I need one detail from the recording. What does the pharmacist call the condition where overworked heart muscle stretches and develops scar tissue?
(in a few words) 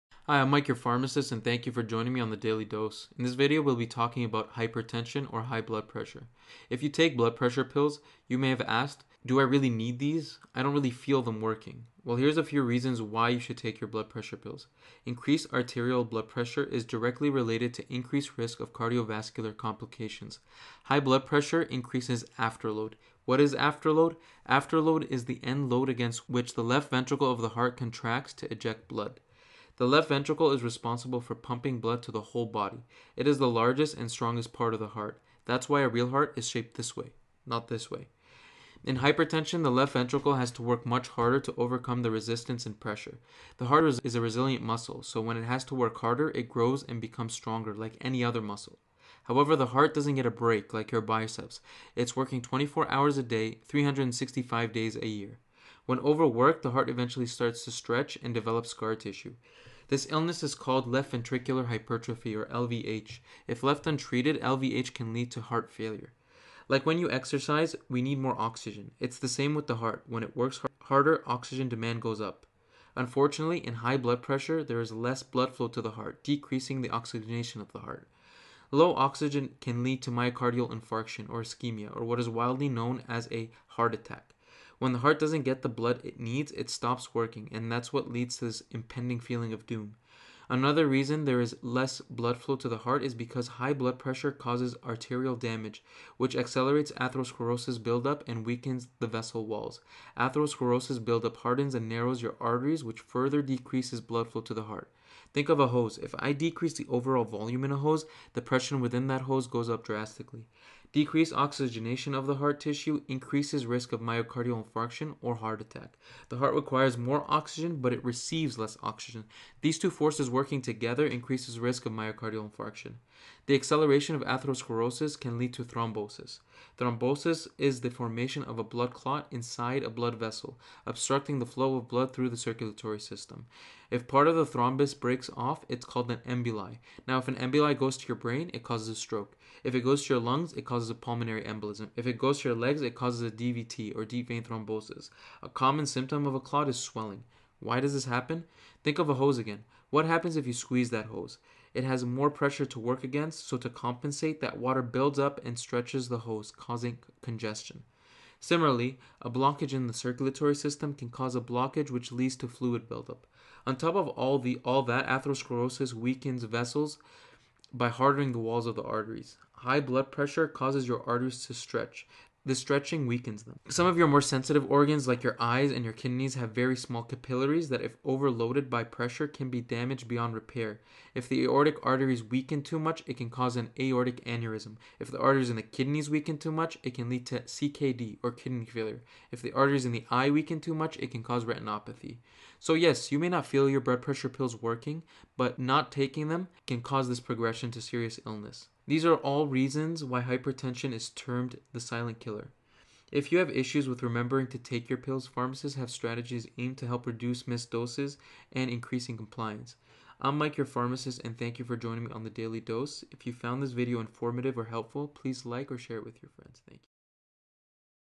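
left ventricular hypertrophy.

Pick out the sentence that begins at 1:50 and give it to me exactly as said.
Decreased oxygenation of the heart tissue increases risk of myocardial infarction or heart attack.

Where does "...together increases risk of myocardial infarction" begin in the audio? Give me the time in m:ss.
2:00.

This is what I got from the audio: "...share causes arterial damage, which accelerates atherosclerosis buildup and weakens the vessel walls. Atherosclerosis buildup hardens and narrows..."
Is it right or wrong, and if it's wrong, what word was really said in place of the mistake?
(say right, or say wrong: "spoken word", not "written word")
wrong: "pressure", not "share".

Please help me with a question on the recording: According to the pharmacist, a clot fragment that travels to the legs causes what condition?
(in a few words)
deep vein thrombosis.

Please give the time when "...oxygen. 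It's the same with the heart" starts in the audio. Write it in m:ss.
1:08.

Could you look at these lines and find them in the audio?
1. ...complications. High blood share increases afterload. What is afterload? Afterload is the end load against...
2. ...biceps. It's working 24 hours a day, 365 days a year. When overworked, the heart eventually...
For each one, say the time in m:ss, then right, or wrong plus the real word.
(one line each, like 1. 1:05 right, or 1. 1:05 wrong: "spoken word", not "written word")
1. 0:19 wrong: "pressure", not "share"
2. 0:51 right.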